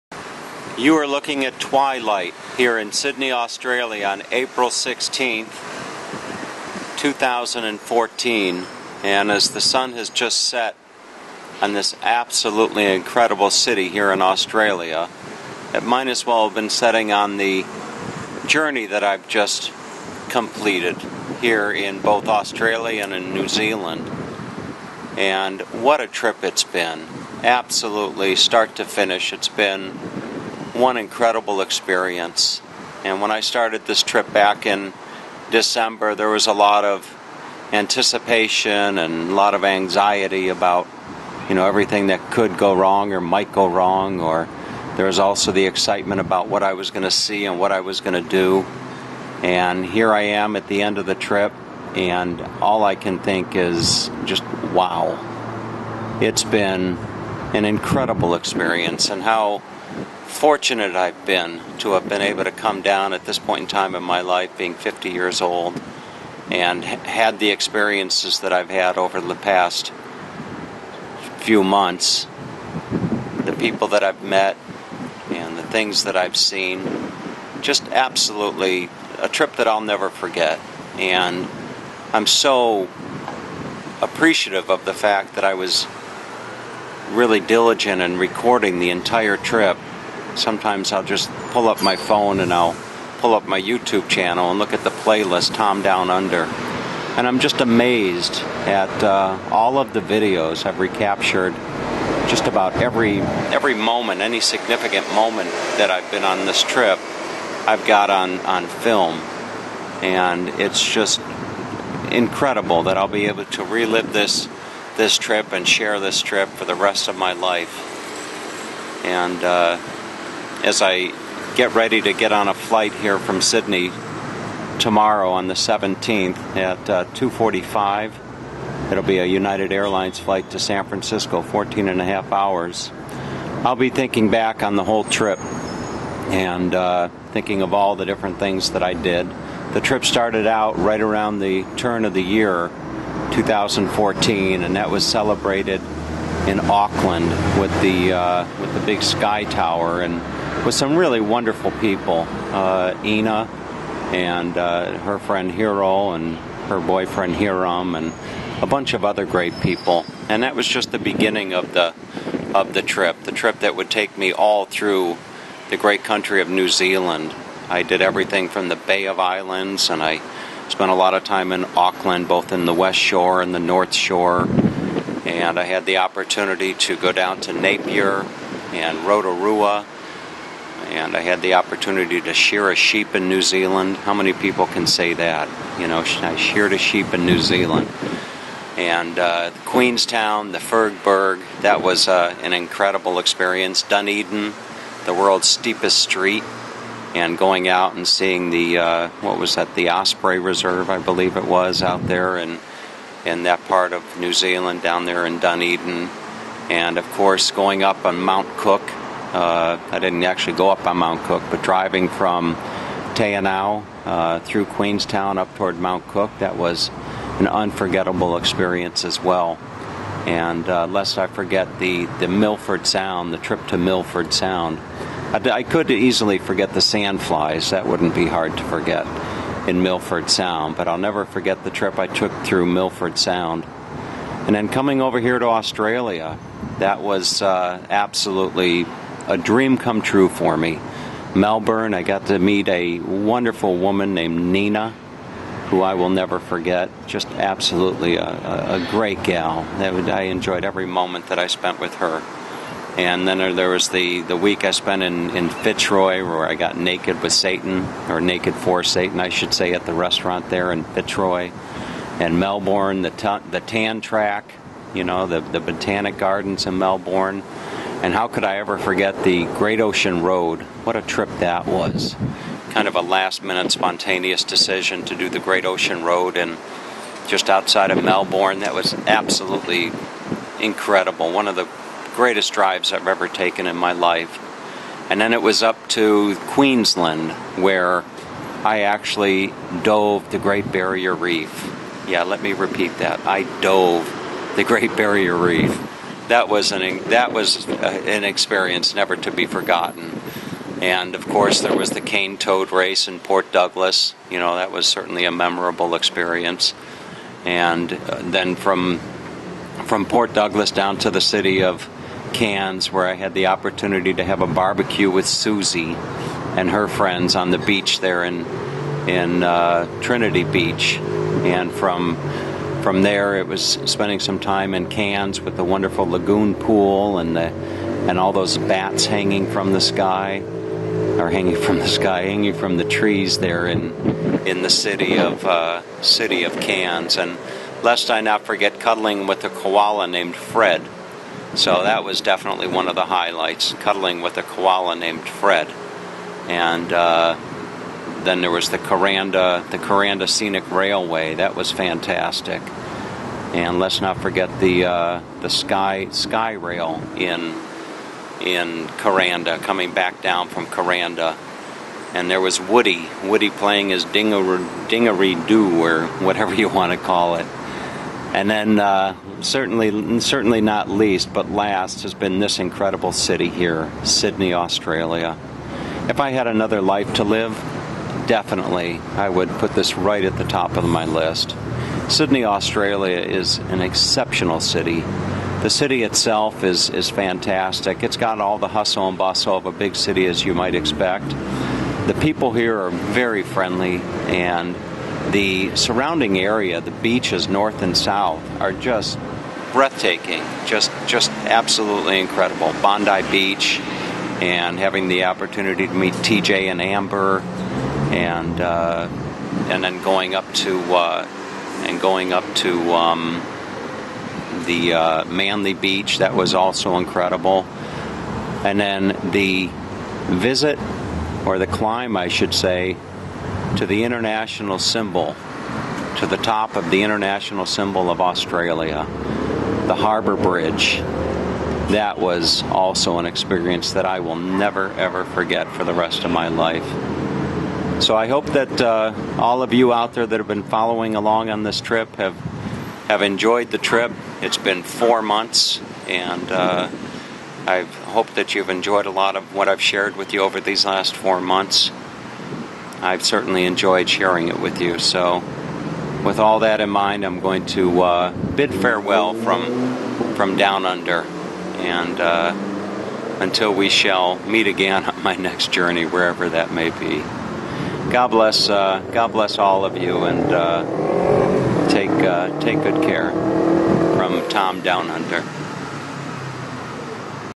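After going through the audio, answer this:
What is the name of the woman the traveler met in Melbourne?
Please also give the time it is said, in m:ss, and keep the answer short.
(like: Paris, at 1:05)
Nina, at 4:04.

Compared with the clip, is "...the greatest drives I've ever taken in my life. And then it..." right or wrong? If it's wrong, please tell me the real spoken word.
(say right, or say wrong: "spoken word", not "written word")
right.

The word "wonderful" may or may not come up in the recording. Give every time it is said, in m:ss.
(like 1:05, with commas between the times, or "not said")
2:31, 4:02, 5:25.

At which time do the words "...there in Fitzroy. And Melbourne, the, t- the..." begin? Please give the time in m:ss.
4:20.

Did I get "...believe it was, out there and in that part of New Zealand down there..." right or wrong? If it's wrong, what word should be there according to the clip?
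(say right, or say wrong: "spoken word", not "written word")
right.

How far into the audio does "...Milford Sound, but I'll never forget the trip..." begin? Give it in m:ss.
3:49.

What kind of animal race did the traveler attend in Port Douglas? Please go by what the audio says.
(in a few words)
cane toad race.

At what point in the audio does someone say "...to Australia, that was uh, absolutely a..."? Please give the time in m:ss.
3:55.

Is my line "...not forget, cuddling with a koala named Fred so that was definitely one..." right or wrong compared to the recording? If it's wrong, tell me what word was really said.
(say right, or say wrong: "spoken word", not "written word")
right.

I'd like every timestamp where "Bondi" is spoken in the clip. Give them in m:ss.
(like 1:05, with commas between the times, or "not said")
6:42.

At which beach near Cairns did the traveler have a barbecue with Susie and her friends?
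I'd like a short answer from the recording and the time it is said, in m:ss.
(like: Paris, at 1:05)
Trinity Beach, at 5:20.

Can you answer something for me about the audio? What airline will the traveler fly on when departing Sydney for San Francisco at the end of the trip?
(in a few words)
United Airlines.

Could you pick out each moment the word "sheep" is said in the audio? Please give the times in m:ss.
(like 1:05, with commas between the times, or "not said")
3:02, 3:06.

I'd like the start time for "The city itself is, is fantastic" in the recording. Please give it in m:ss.
6:25.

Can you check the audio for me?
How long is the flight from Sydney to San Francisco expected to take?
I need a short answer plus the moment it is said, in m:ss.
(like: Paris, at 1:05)
14 and a half hours, at 2:11.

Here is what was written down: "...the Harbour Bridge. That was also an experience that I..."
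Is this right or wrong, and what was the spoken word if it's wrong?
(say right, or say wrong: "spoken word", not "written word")
right.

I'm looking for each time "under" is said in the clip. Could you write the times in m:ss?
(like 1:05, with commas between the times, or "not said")
1:36, 7:40, 7:55.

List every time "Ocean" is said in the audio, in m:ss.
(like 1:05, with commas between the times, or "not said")
4:29, 4:35.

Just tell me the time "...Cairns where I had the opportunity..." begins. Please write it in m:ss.
5:12.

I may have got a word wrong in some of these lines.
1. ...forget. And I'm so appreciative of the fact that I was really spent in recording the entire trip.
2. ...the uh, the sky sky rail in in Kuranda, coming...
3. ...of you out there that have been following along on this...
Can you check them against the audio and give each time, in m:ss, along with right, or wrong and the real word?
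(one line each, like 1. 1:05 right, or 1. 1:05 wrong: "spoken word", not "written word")
1. 1:20 wrong: "diligent", not "spent"
2. 5:54 right
3. 7:19 right.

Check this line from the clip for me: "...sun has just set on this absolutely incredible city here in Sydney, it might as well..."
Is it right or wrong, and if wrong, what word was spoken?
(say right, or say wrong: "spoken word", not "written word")
wrong: "Australia", not "Sydney".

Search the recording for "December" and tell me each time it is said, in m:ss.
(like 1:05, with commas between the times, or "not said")
0:35.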